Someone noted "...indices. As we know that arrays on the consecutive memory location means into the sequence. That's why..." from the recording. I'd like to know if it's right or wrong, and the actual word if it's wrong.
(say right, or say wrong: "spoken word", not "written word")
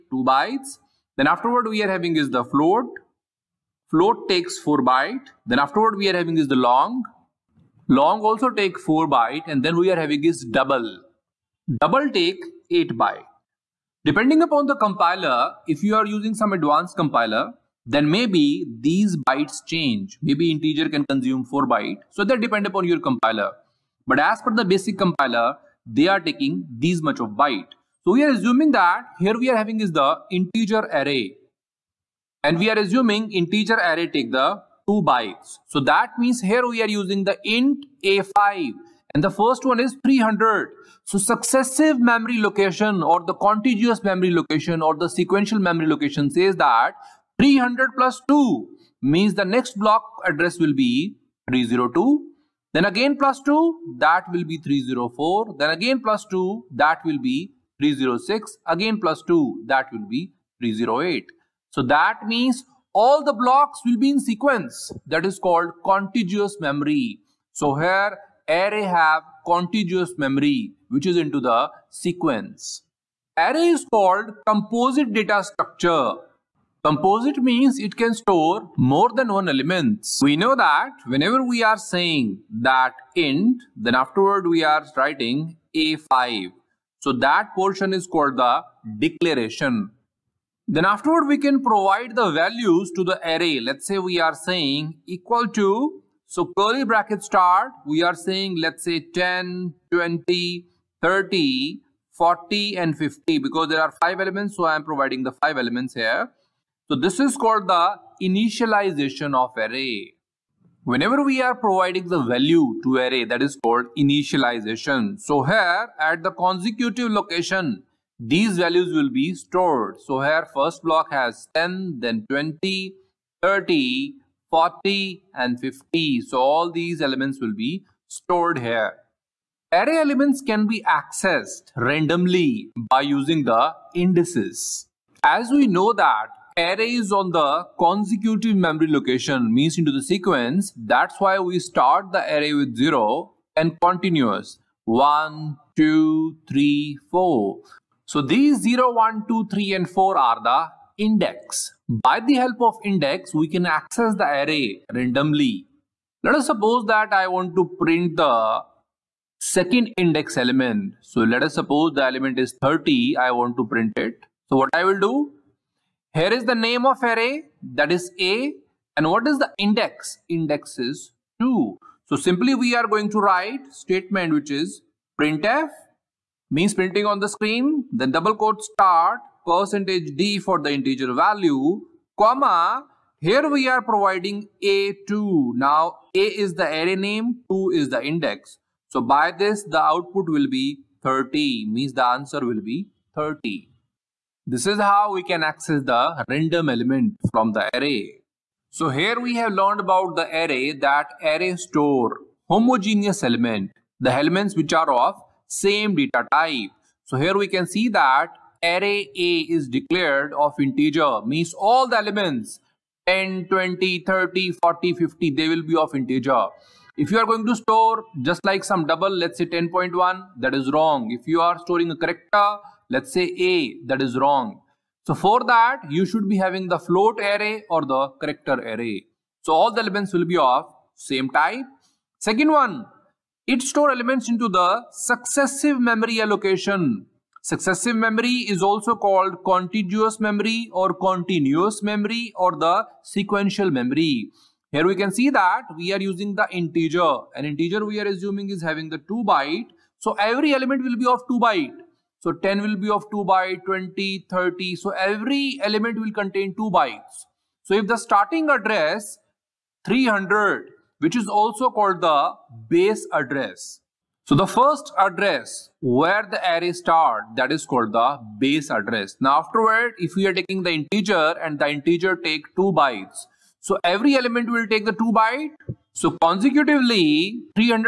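right.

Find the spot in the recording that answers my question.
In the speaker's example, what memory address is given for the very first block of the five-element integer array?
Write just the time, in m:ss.
0:39.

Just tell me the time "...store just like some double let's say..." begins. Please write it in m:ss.
3:37.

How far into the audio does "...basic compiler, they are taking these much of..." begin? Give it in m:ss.
0:24.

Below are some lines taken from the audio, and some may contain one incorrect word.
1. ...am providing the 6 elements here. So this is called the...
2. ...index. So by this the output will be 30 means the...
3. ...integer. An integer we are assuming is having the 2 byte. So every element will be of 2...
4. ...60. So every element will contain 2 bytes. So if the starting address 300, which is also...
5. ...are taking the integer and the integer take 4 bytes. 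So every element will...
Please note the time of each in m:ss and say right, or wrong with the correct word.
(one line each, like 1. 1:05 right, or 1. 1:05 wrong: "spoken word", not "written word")
1. 1:44 wrong: "5", not "6"
2. 3:08 right
3. 4:06 right
4. 4:14 wrong: "30", not "60"
5. 4:30 wrong: "2", not "4".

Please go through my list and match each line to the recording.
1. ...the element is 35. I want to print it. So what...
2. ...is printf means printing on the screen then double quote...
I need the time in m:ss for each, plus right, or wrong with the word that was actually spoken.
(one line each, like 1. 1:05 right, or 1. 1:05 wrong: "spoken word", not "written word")
1. 2:41 wrong: "30", not "35"
2. 2:54 right.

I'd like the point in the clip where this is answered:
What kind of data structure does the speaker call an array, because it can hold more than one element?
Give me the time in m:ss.
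1:13.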